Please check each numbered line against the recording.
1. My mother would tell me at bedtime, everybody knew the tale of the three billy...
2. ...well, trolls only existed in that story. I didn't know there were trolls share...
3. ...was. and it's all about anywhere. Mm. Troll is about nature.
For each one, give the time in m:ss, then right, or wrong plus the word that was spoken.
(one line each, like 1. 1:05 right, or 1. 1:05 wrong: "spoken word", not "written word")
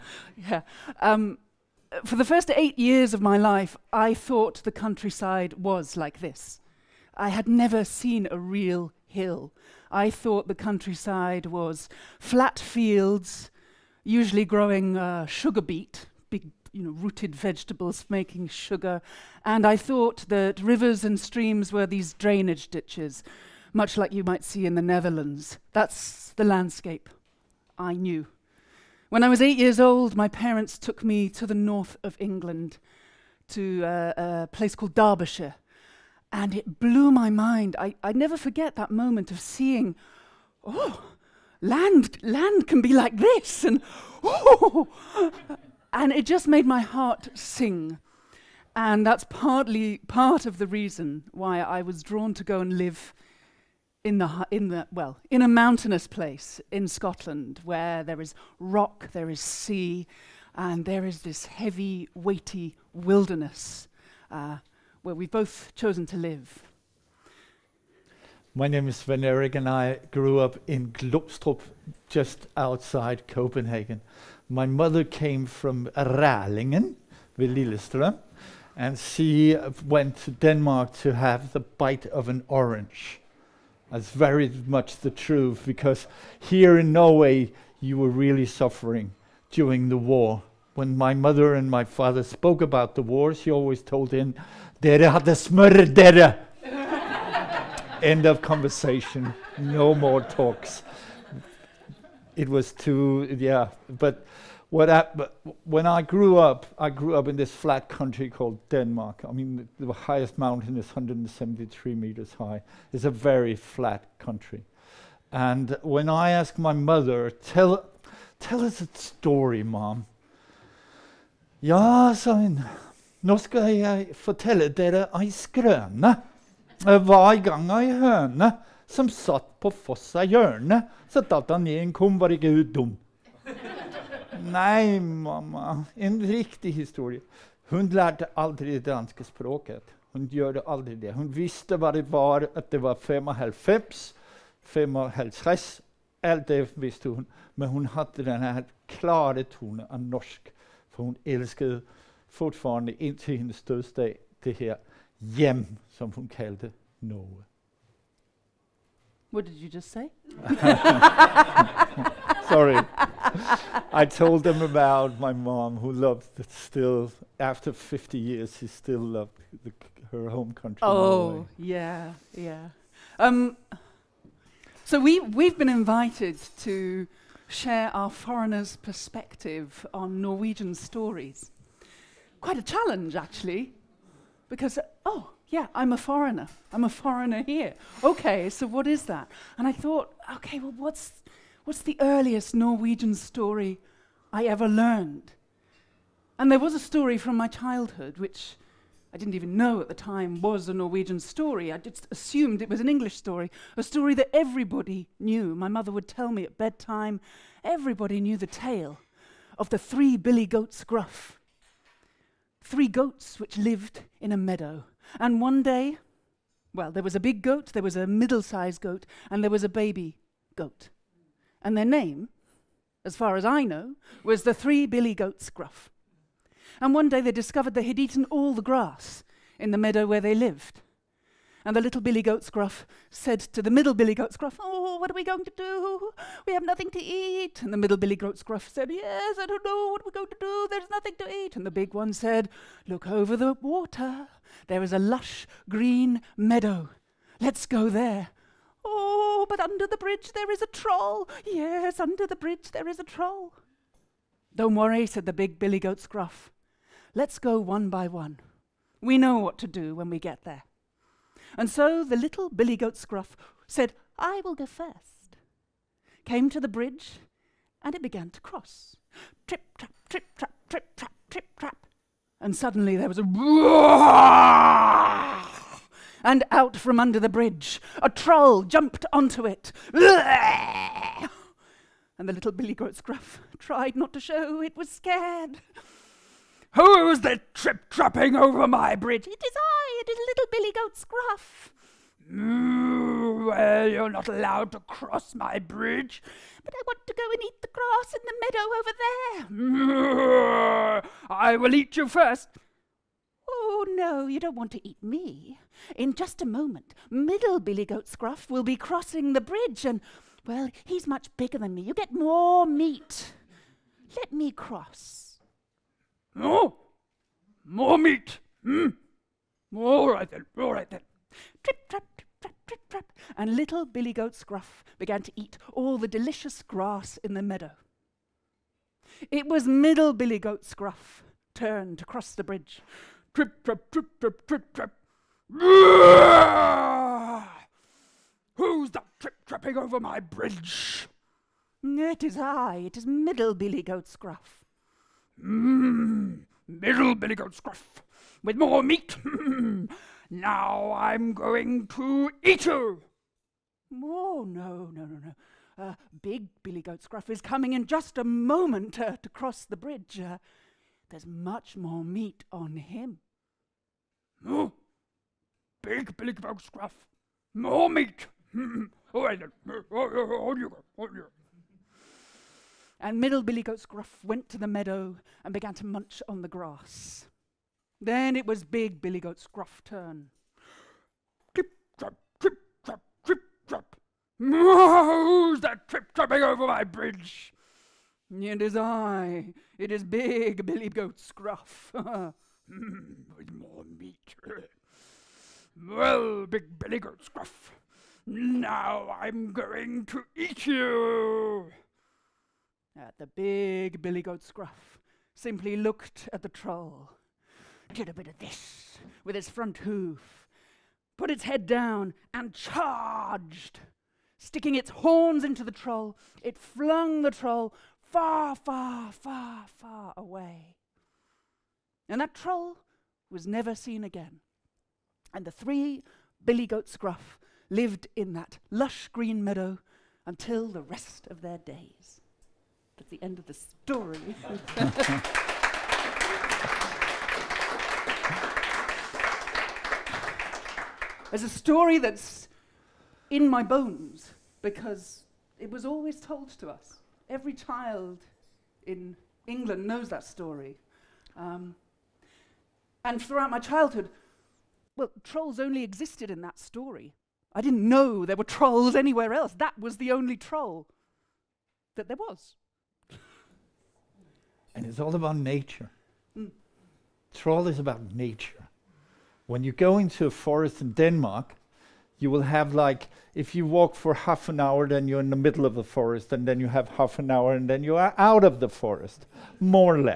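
1. 3:25 right
2. 7:34 wrong: "anywhere", not "share"
3. 7:42 wrong: "nature", not "anywhere".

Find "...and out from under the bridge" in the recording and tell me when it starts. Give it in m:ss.
4:36.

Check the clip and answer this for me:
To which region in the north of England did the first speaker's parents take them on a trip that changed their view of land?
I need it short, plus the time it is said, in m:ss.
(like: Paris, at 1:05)
Derbyshire, at 0:34.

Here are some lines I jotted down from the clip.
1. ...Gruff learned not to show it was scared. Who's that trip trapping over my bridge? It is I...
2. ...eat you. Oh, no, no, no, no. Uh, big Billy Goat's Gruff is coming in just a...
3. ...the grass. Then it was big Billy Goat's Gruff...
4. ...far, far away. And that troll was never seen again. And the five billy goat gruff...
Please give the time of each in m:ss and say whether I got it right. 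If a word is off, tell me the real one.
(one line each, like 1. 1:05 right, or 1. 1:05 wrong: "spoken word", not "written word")
1. 4:43 wrong: "tried", not "learned"
2. 5:52 right
3. 6:16 right
4. 6:59 wrong: "three", not "five".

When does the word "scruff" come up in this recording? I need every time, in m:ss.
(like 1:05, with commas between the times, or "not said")
6:06, 6:37.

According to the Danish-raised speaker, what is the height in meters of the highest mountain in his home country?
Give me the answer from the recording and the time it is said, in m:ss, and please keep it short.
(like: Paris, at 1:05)
173, at 1:50.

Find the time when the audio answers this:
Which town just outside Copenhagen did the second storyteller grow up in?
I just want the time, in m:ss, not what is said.
1:10.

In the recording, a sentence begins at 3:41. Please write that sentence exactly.
And their name, as far as I know, was the three billy goats gruff.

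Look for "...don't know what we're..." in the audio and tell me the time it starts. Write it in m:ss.
3:59.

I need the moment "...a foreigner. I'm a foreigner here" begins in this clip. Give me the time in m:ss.
3:05.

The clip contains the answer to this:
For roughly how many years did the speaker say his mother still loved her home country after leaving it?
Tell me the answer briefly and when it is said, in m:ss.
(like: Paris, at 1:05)
50, at 2:47.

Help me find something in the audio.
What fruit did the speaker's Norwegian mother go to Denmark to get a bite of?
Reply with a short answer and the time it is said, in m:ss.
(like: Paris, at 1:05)
An orange, at 1:22.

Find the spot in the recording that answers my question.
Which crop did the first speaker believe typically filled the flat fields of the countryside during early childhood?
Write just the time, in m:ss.
0:15.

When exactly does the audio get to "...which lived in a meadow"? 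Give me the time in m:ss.
3:33.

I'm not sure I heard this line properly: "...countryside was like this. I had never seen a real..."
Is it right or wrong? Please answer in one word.
right.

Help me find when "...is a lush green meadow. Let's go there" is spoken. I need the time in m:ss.
4:04.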